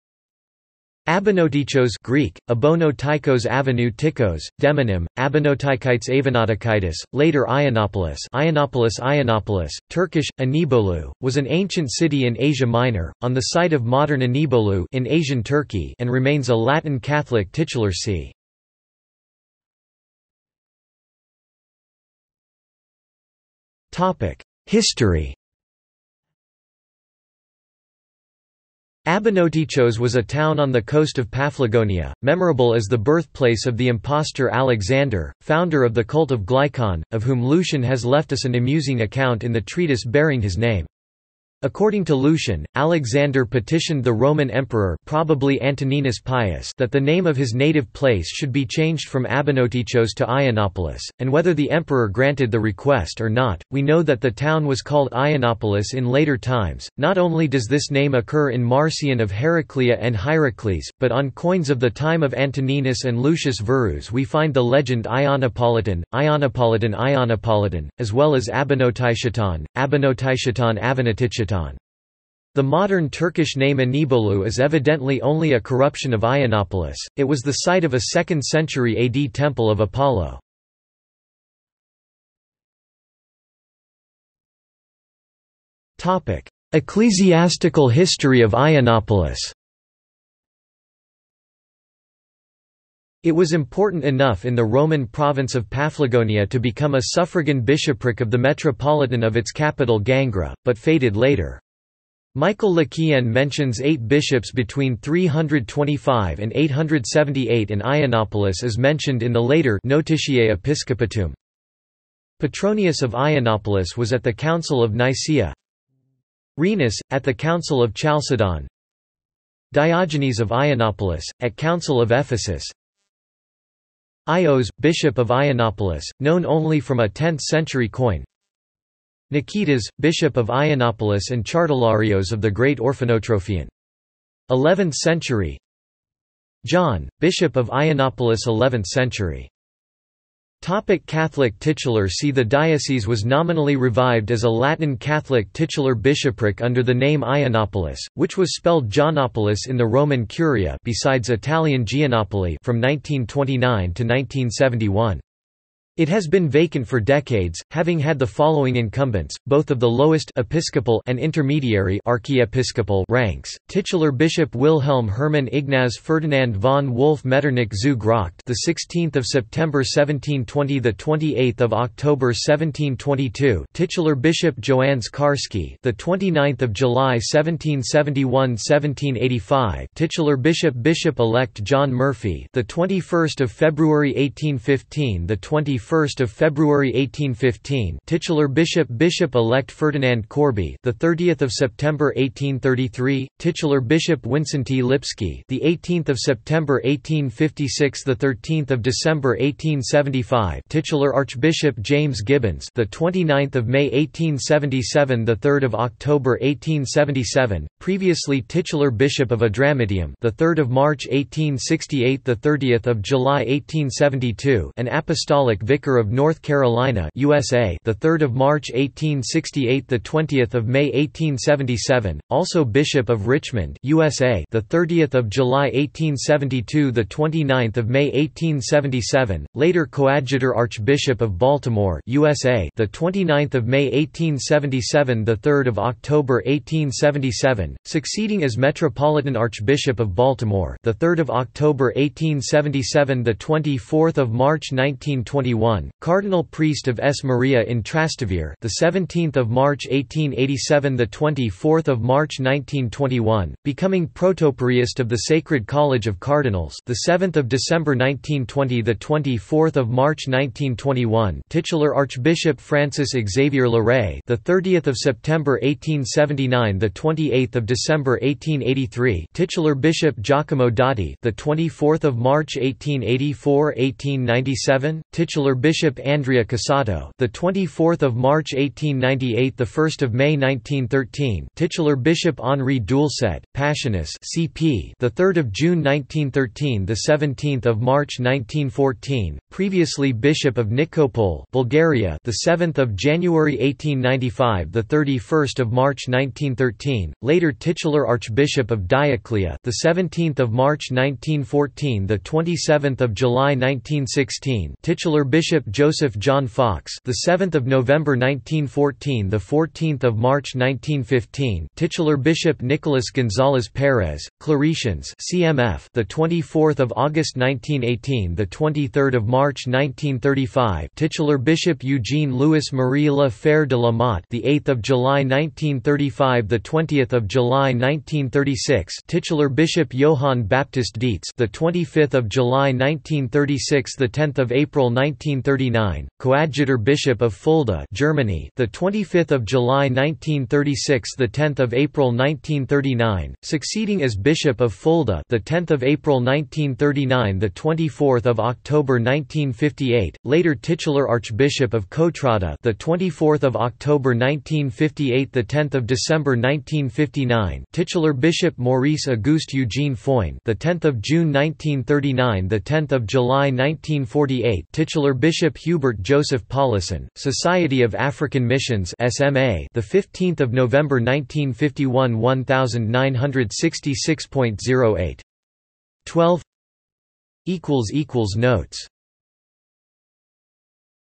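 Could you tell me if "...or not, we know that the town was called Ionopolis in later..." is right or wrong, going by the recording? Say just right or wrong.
right.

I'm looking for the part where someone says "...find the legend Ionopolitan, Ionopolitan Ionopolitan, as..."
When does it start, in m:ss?
1:04.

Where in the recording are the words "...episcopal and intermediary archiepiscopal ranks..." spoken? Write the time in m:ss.
2:40.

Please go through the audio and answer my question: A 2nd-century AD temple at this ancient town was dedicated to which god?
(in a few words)
Apollo.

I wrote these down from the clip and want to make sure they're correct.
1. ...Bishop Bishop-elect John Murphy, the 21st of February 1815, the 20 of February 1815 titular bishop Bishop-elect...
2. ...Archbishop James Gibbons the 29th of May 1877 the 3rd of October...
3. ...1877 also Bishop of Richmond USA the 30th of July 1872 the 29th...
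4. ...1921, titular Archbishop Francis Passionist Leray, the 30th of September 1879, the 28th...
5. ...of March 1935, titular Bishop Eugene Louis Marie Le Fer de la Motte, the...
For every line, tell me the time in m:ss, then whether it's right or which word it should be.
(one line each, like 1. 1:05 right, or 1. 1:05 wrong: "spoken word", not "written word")
1. 3:00 right
2. 3:21 right
3. 3:40 right
4. 4:20 wrong: "Xavier", not "Passionist"
5. 5:19 right.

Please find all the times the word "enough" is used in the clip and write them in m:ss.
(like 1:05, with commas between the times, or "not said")
1:34.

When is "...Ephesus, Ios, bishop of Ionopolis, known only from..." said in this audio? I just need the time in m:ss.
2:02.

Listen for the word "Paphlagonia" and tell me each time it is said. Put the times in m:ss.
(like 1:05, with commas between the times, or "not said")
0:31, 1:35.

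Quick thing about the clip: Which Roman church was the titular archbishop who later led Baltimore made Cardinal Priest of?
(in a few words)
S. Maria in Trastevere.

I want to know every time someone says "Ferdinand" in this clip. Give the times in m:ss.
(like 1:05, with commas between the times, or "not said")
2:45, 3:09.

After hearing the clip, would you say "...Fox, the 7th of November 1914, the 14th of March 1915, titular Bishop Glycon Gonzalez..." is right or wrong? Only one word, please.
wrong.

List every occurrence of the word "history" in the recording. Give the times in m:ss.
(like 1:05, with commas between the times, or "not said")
0:24, 1:27.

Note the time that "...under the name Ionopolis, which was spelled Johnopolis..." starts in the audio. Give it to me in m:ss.
2:26.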